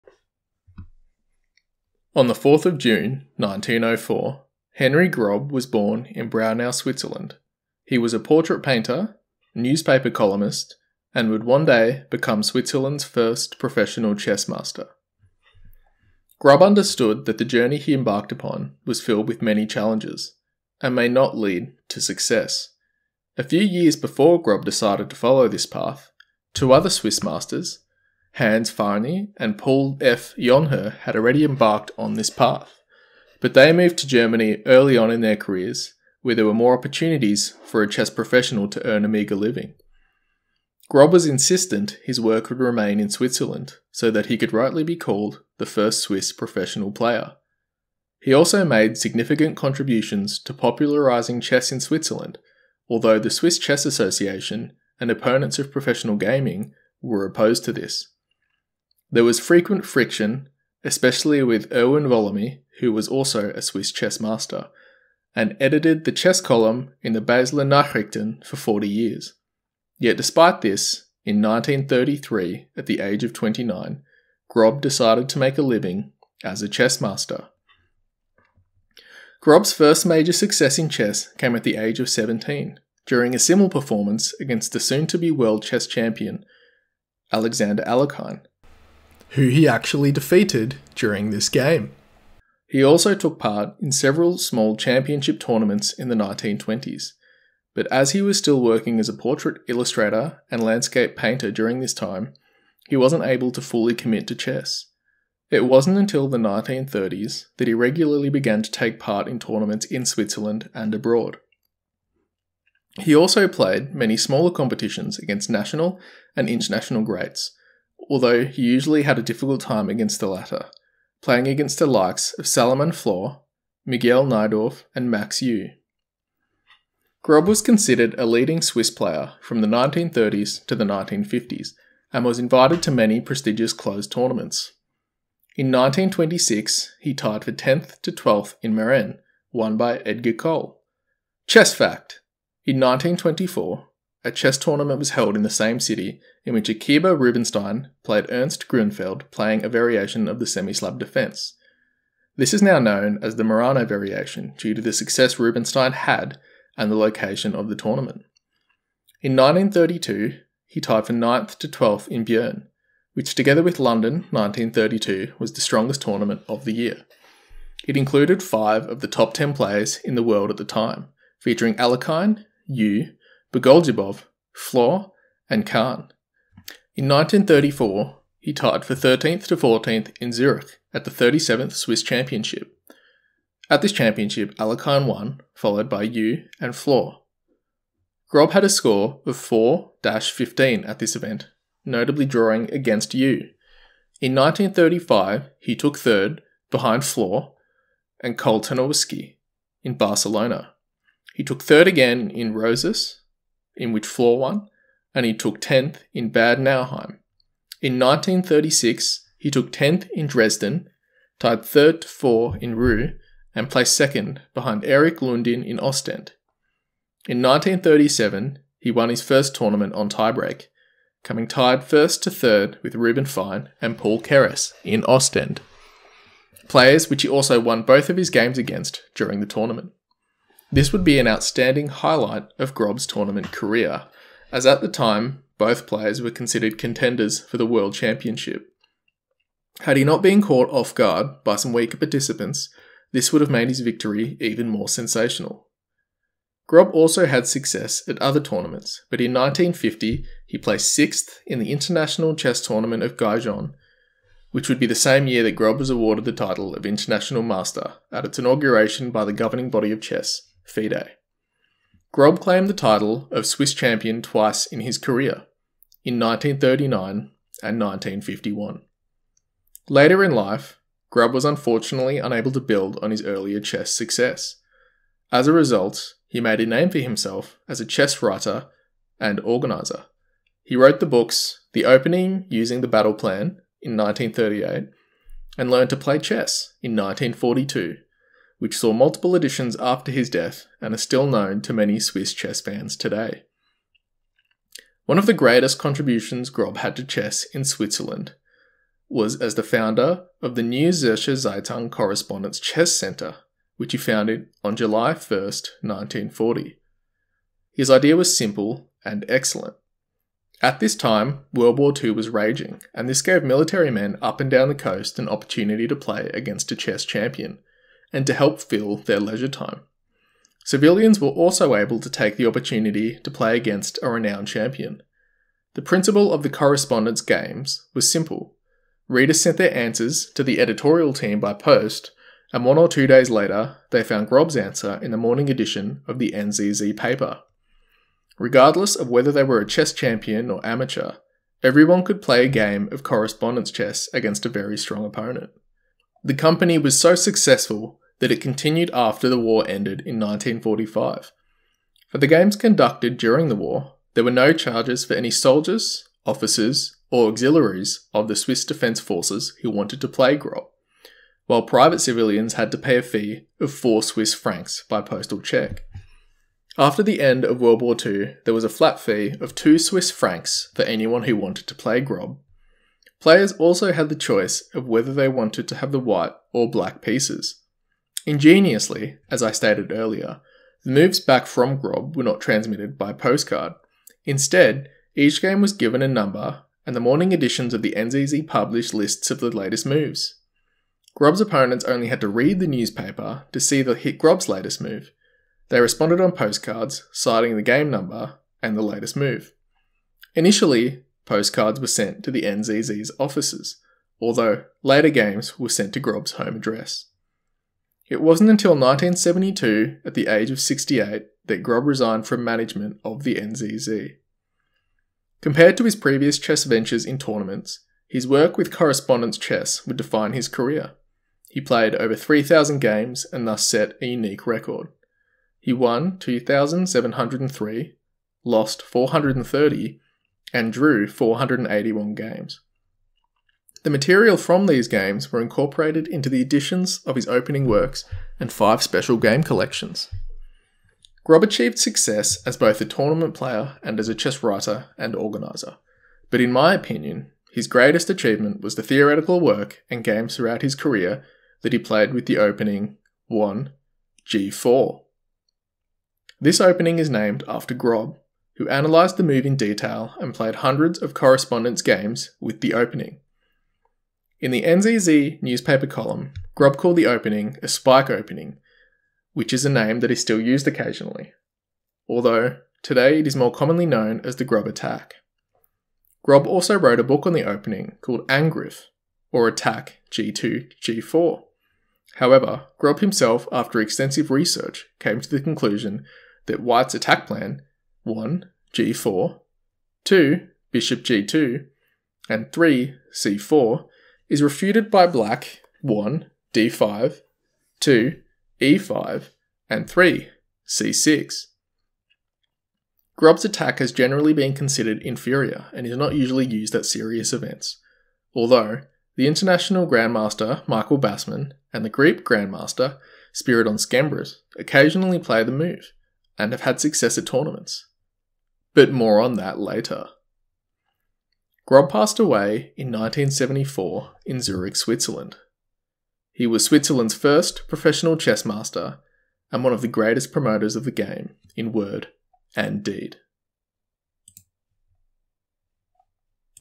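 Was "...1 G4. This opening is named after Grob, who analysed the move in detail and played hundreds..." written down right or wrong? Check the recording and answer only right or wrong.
right.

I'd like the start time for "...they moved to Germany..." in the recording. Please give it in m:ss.
0:33.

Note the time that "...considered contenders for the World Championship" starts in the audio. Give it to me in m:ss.
3:56.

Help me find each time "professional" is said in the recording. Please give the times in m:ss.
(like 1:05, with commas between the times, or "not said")
0:13, 0:38, 0:46, 0:55, 8:47.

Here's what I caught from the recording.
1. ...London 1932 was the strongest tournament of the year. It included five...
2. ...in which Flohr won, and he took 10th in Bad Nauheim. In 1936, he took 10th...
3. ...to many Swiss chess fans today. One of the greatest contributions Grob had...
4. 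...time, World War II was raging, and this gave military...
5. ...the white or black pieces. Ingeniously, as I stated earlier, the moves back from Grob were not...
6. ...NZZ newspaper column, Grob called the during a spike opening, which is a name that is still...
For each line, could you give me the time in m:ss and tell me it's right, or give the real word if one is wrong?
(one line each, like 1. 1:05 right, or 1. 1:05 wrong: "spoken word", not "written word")
1. 2:43 right
2. 3:23 right
3. 4:51 right
4. 5:10 right
5. 6:15 right
6. 7:44 wrong: "opening", not "during".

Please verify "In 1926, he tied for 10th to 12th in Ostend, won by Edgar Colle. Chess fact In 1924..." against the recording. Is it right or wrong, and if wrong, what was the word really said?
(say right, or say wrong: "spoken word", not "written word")
wrong: "Merano", not "Ostend".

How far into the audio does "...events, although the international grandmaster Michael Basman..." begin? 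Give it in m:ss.
8:27.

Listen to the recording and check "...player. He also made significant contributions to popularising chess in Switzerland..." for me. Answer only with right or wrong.
right.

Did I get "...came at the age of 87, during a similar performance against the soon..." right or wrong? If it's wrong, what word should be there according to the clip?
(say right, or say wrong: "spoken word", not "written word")
wrong: "17", not "87".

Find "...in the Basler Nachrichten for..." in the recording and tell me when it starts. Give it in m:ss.
1:07.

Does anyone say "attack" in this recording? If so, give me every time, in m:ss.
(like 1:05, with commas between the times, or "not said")
7:54, 7:59, 8:06, 8:23.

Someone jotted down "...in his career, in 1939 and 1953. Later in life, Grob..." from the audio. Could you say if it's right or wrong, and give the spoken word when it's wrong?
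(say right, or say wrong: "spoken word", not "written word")
wrong: "1951", not "1953".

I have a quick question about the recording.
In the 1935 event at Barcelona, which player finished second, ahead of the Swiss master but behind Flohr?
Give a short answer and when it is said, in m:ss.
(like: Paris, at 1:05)
Koltanowski, at 3:18.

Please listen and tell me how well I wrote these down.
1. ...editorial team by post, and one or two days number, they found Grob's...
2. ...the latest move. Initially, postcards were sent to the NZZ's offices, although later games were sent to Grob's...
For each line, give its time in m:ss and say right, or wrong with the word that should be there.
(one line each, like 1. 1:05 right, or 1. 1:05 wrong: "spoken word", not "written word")
1. 5:30 wrong: "later", not "number"
2. 6:38 right.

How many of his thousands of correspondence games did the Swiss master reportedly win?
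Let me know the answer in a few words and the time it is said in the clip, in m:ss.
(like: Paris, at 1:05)
2703, at 7:06.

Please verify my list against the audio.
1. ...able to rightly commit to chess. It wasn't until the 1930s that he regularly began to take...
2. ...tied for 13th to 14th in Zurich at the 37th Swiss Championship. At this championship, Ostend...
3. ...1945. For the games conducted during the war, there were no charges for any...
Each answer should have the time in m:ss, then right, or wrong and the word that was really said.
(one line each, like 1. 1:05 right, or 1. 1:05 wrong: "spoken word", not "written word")
1. 1:43 wrong: "fully", not "rightly"
2. 2:58 wrong: "Alekhine", not "Ostend"
3. 5:50 right.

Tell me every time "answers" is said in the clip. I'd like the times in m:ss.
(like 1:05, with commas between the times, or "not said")
5:29, 5:34.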